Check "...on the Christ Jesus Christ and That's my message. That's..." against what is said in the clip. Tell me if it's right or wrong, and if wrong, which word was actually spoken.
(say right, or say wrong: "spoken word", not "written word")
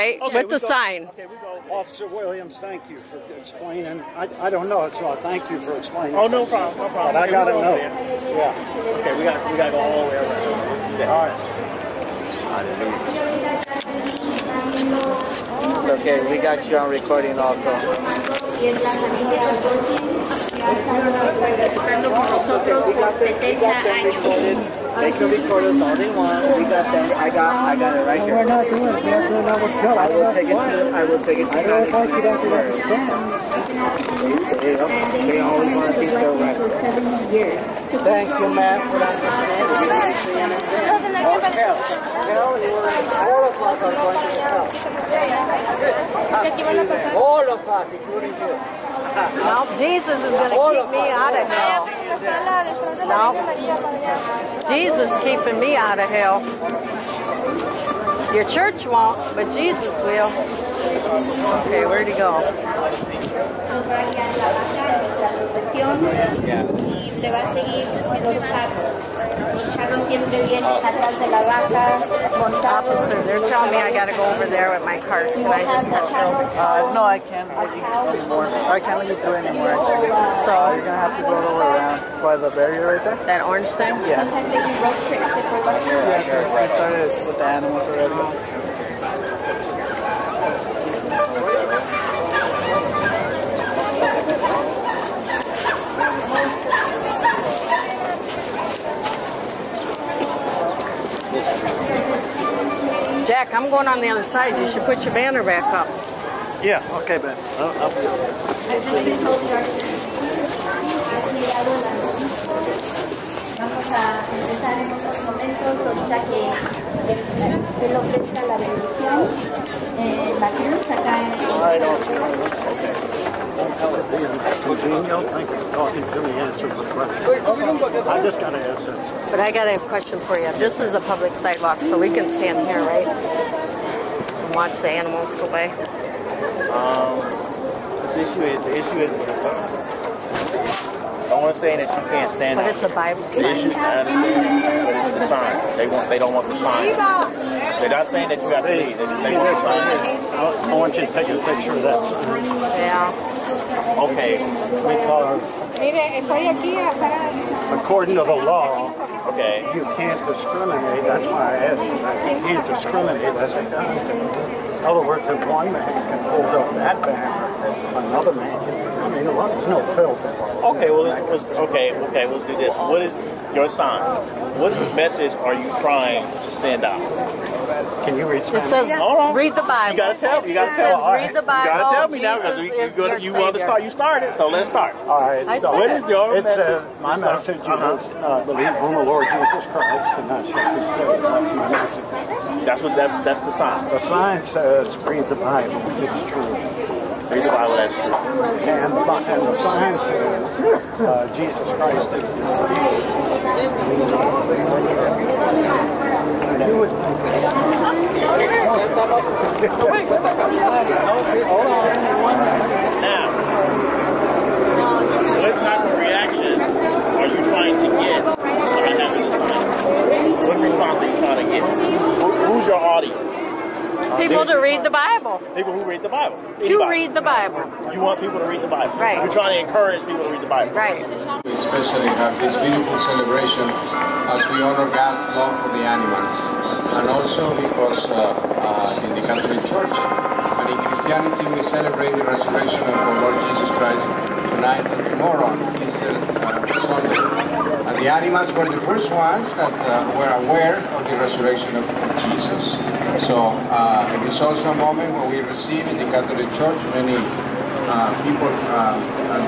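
wrong: "Lord", not "Christ".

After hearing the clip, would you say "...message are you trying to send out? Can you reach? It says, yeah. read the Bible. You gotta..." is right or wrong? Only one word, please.
right.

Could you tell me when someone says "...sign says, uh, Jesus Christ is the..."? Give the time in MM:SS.
03:19.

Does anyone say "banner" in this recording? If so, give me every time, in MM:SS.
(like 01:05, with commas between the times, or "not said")
01:45, 02:47.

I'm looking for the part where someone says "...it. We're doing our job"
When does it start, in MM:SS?
00:28.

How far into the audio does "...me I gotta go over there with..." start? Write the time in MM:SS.
01:13.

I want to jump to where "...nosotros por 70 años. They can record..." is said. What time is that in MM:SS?
00:22.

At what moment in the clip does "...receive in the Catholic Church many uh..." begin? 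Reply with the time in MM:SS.
04:15.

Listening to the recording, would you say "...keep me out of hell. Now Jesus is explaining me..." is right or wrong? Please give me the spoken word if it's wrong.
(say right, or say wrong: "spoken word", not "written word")
wrong: "keeping", not "explaining".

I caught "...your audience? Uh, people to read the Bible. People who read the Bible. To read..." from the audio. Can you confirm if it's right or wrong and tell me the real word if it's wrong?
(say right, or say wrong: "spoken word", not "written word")
right.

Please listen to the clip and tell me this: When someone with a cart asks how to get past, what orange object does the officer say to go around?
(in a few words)
The barrier.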